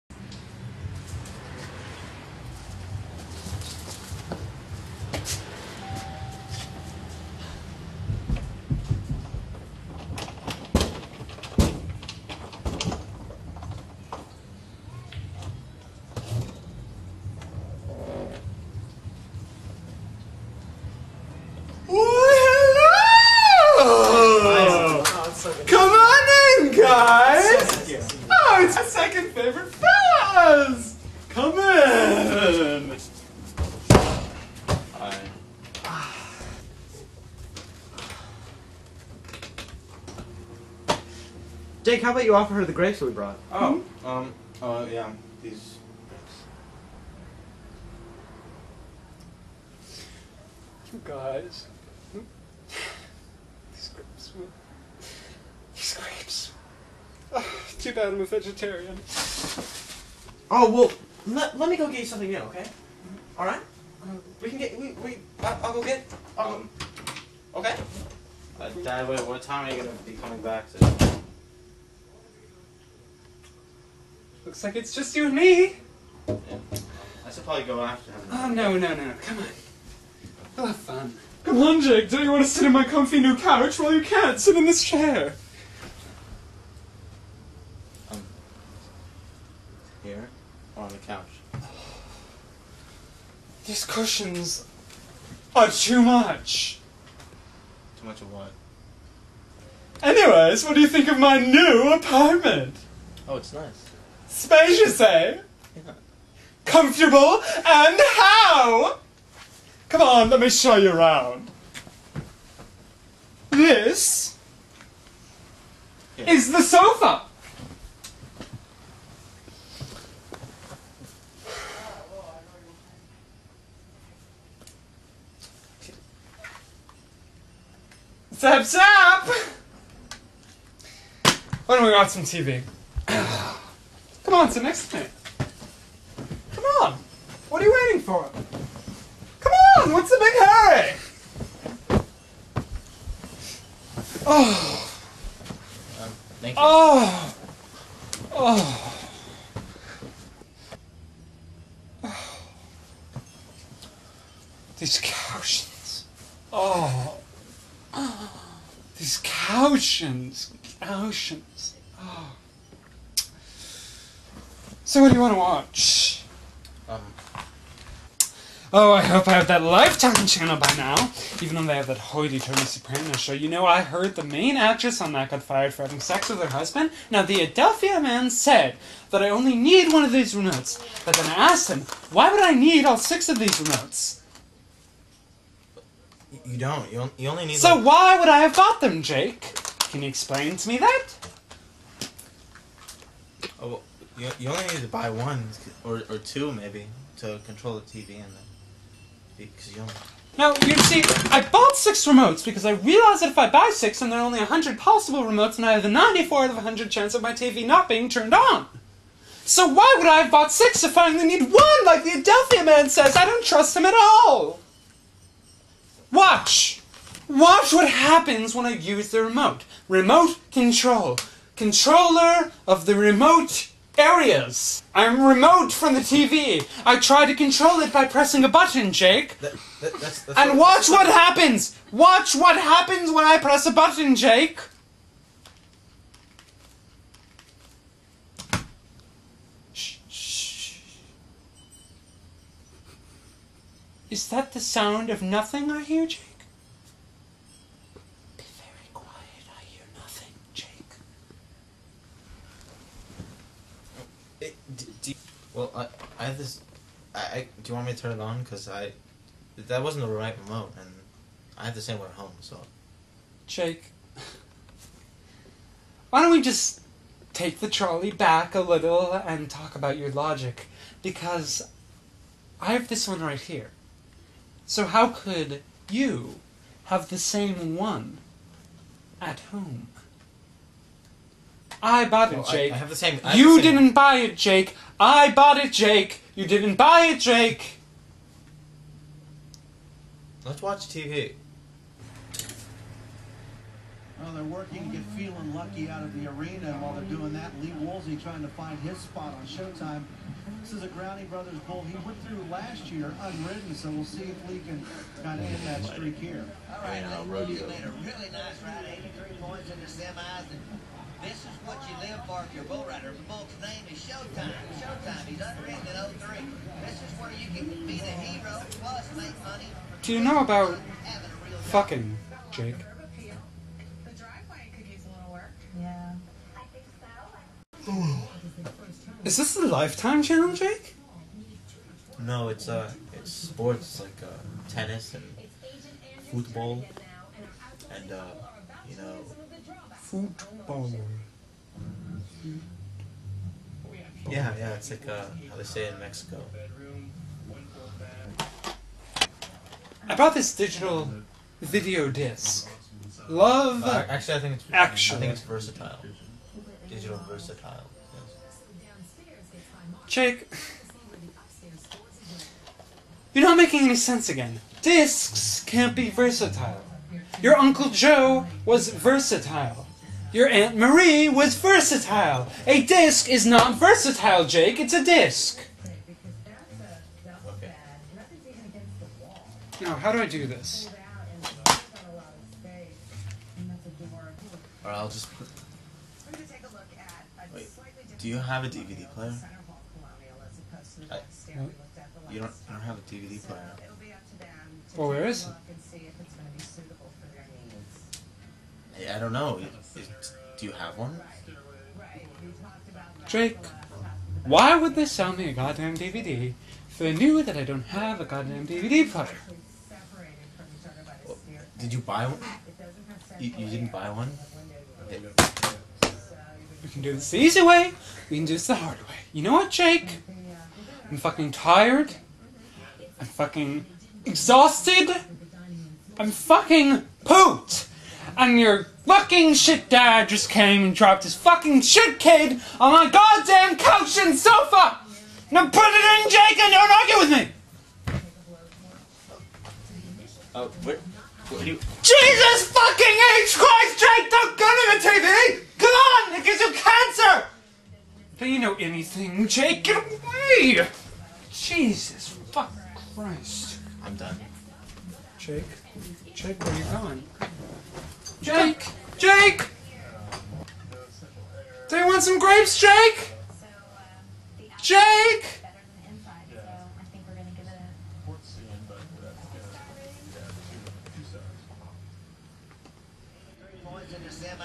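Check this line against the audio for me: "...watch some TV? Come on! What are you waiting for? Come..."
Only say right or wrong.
right.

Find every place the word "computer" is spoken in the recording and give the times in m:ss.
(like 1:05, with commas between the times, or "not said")
not said.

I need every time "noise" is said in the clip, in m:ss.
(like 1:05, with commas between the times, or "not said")
not said.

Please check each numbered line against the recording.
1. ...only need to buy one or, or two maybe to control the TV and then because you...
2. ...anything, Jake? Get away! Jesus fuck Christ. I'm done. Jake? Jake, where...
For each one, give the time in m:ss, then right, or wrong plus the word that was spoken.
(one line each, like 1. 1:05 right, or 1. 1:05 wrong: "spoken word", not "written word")
1. 3:14 right
2. 7:28 right.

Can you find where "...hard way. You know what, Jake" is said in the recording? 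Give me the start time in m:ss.
6:58.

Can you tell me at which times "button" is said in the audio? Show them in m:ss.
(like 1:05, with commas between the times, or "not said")
3:48, 3:53.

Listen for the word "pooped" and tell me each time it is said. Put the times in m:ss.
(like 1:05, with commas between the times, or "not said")
7:07.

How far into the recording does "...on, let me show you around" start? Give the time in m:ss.
1:50.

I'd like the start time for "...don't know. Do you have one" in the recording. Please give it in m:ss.
6:39.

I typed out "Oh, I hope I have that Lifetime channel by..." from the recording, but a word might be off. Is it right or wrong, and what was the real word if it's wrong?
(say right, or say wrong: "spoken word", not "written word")
right.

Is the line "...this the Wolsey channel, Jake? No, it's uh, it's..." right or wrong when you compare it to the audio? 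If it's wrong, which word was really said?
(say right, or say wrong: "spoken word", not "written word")
wrong: "Lifetime", not "Wolsey".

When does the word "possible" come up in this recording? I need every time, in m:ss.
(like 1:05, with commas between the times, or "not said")
3:24.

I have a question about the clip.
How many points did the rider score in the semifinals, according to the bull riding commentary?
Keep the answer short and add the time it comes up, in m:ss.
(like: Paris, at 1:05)
83, at 5:08.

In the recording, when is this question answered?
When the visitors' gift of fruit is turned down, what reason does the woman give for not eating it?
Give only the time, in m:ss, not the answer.
0:58.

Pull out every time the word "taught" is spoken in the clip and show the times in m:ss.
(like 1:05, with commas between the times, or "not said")
not said.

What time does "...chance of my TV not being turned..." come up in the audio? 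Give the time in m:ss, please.
3:26.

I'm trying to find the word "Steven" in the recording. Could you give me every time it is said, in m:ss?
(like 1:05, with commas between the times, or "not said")
not said.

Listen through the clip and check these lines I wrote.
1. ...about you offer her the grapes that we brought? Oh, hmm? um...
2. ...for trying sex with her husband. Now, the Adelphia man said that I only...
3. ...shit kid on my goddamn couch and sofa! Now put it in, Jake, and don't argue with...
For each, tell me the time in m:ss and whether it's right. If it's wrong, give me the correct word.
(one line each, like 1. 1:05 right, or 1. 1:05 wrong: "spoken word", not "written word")
1. 0:42 right
2. 2:55 wrong: "having", not "trying"
3. 7:11 right.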